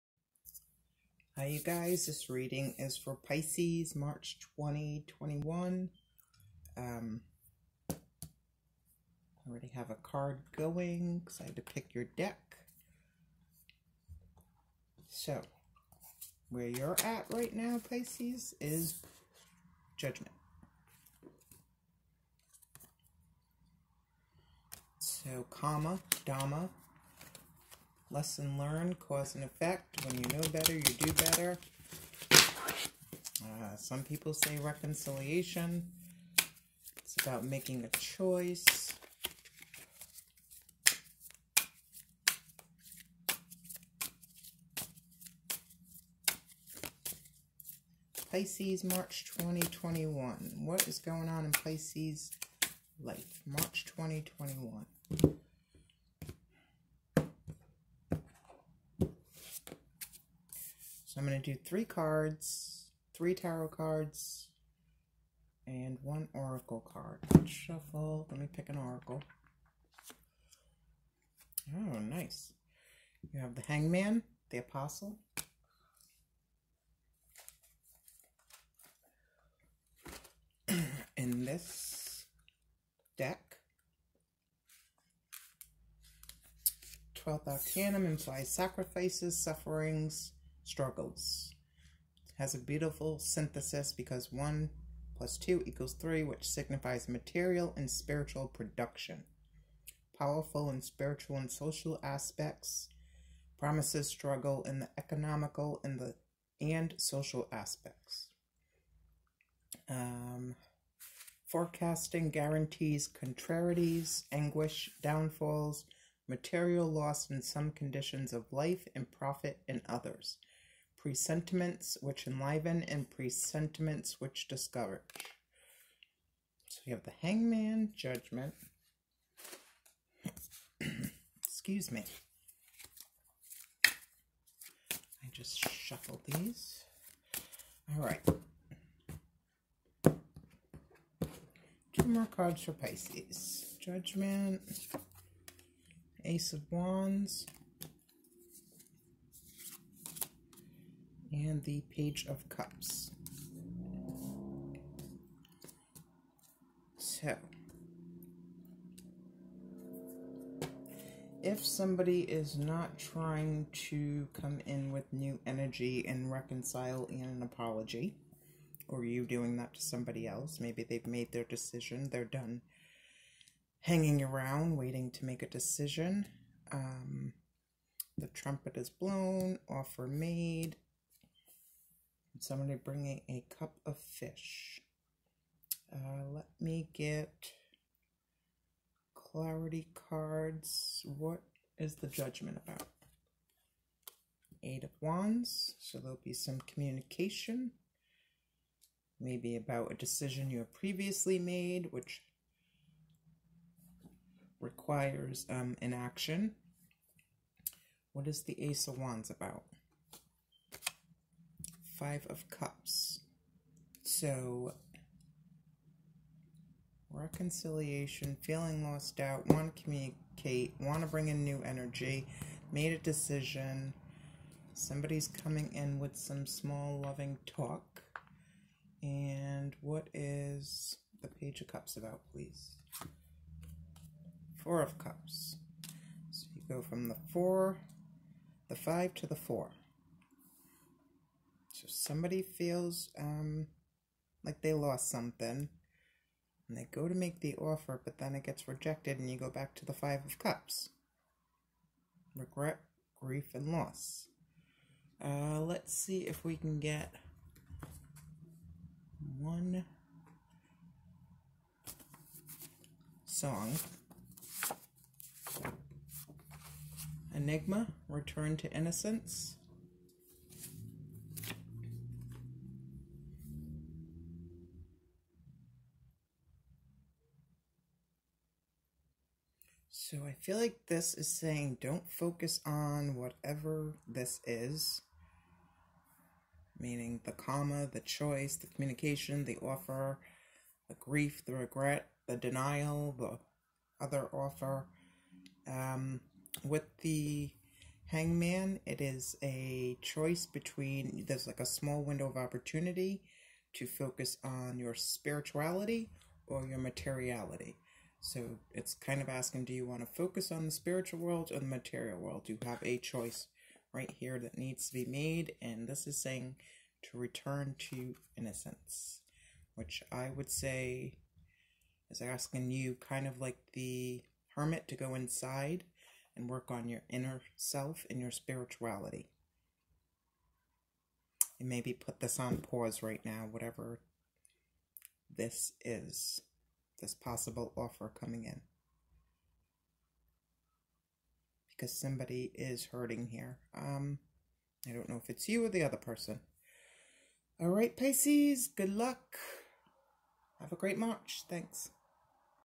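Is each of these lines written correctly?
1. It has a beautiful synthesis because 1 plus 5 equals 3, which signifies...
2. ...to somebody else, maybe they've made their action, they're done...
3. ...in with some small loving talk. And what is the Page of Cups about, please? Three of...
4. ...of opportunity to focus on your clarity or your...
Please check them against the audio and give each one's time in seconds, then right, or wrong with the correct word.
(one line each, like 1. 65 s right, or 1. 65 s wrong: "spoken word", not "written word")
1. 92 s wrong: "2", not "5"
2. 169 s wrong: "decision", not "action"
3. 225 s wrong: "Four", not "Three"
4. 302 s wrong: "spirituality", not "clarity".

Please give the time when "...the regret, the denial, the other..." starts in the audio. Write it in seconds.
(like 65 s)
291 s.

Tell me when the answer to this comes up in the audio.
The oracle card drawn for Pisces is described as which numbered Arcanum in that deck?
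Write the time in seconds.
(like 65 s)
87 s.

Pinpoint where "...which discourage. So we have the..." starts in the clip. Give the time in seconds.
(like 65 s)
124 s.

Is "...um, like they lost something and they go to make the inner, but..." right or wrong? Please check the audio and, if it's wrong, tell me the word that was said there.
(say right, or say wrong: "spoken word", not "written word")
wrong: "offer", not "inner".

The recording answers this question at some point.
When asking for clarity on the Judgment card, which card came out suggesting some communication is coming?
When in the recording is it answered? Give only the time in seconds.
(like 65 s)
194 s.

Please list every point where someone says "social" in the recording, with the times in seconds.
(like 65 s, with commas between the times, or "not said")
101 s, 106 s.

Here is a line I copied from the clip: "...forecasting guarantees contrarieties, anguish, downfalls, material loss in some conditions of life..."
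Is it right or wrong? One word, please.
right.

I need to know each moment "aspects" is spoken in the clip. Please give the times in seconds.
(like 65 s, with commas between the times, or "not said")
102 s, 107 s.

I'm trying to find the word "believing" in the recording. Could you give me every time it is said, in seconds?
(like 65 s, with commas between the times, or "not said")
not said.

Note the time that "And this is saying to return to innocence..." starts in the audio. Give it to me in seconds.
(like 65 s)
315 s.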